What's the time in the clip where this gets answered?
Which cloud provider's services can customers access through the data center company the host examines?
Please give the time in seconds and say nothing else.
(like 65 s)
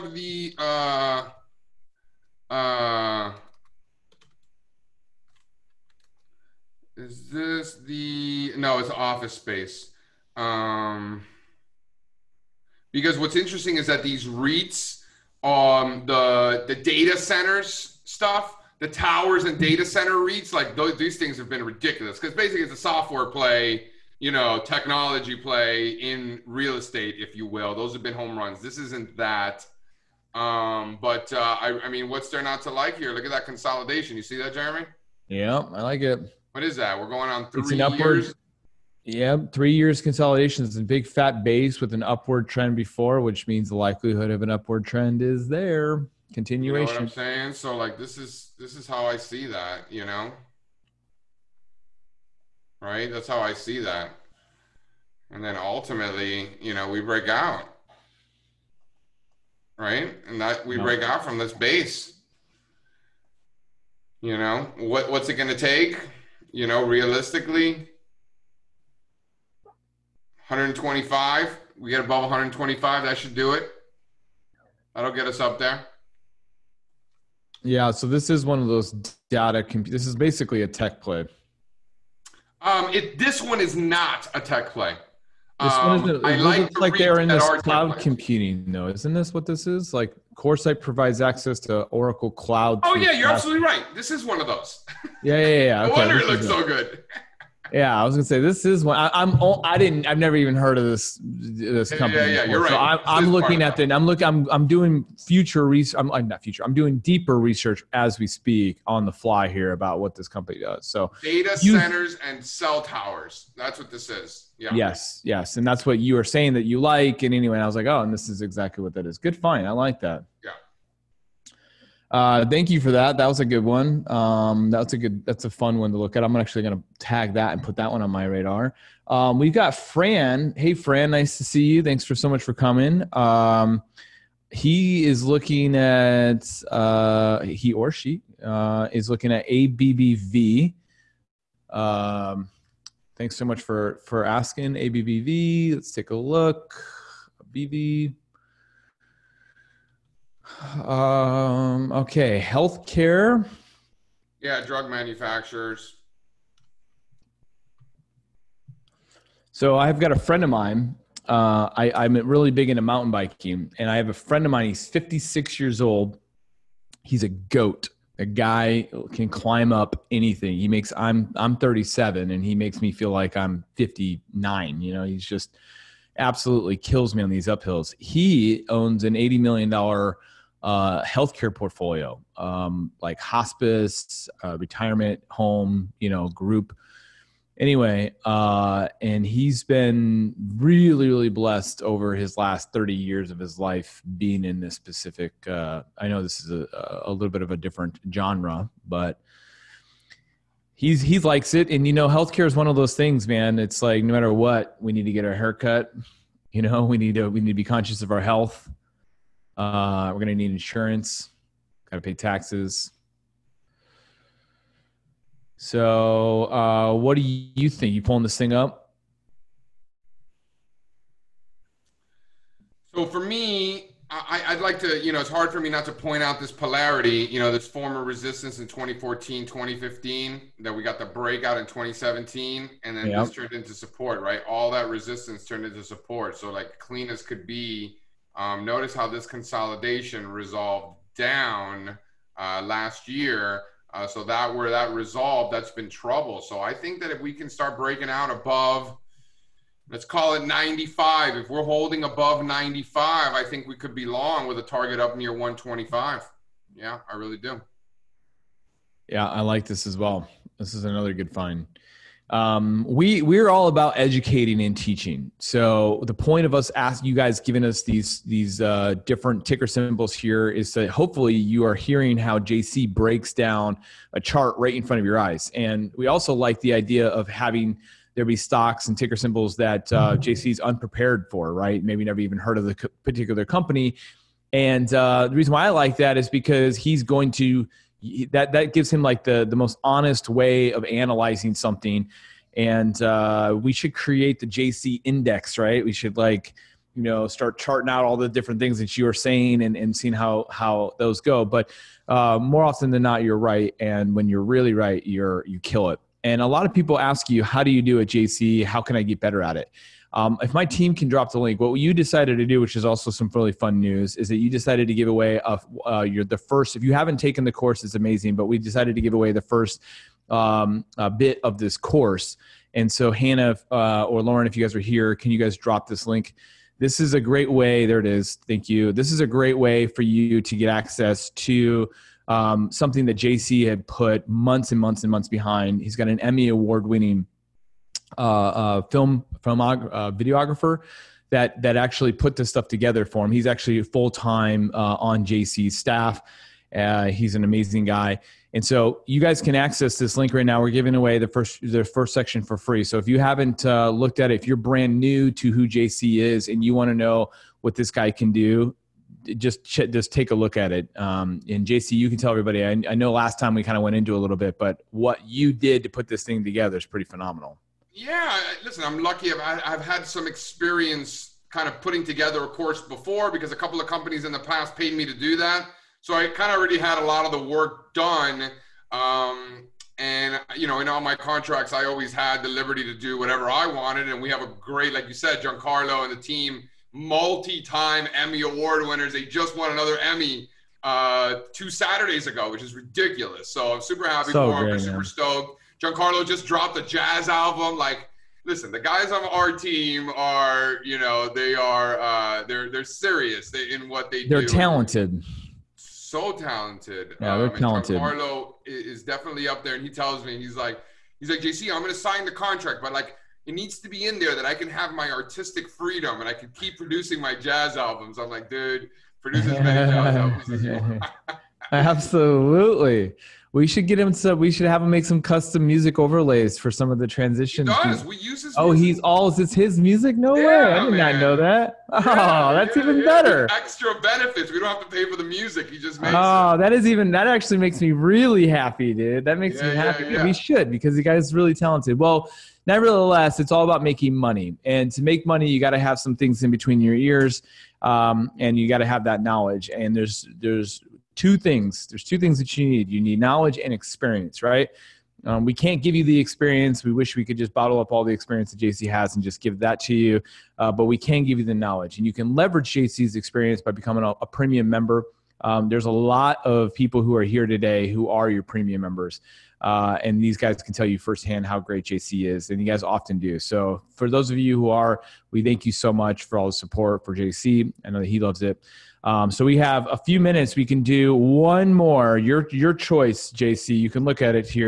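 91 s.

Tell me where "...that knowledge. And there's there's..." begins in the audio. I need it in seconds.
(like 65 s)
449 s.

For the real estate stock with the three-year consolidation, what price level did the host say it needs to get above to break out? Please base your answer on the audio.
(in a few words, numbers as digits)
125.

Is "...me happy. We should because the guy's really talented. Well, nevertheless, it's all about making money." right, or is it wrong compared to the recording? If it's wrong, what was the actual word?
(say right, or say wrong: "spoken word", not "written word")
right.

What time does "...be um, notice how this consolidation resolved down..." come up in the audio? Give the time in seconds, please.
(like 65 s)
237 s.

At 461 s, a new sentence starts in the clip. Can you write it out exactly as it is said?
And you can leverage JC's experience by becoming a, a premium member.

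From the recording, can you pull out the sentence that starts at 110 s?
So data you, centers and cell towers.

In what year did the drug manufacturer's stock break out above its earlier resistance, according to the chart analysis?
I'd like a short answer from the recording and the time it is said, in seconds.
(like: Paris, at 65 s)
2017, at 231 s.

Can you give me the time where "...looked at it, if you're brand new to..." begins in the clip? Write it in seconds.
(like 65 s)
353 s.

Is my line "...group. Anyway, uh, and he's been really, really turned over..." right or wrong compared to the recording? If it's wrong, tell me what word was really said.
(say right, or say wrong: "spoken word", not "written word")
wrong: "blessed", not "turned".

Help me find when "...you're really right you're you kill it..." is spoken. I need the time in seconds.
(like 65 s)
304 s.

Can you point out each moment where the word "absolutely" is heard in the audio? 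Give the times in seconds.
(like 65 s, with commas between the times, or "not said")
93 s, 176 s, 421 s.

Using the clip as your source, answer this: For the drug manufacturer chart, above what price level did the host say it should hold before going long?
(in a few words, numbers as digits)
95.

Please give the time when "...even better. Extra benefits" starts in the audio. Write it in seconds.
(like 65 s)
432 s.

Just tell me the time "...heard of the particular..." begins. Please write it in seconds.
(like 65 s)
282 s.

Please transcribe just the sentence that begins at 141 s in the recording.
Um, thanks so much for for asking ABBV.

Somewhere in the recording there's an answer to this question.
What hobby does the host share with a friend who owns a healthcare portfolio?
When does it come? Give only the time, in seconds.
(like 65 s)
162 s.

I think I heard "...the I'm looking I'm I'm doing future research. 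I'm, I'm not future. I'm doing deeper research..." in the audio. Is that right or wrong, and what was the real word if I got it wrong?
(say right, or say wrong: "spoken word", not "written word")
right.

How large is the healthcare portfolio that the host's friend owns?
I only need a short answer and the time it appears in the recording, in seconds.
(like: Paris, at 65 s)
80 million dollars, at 179 s.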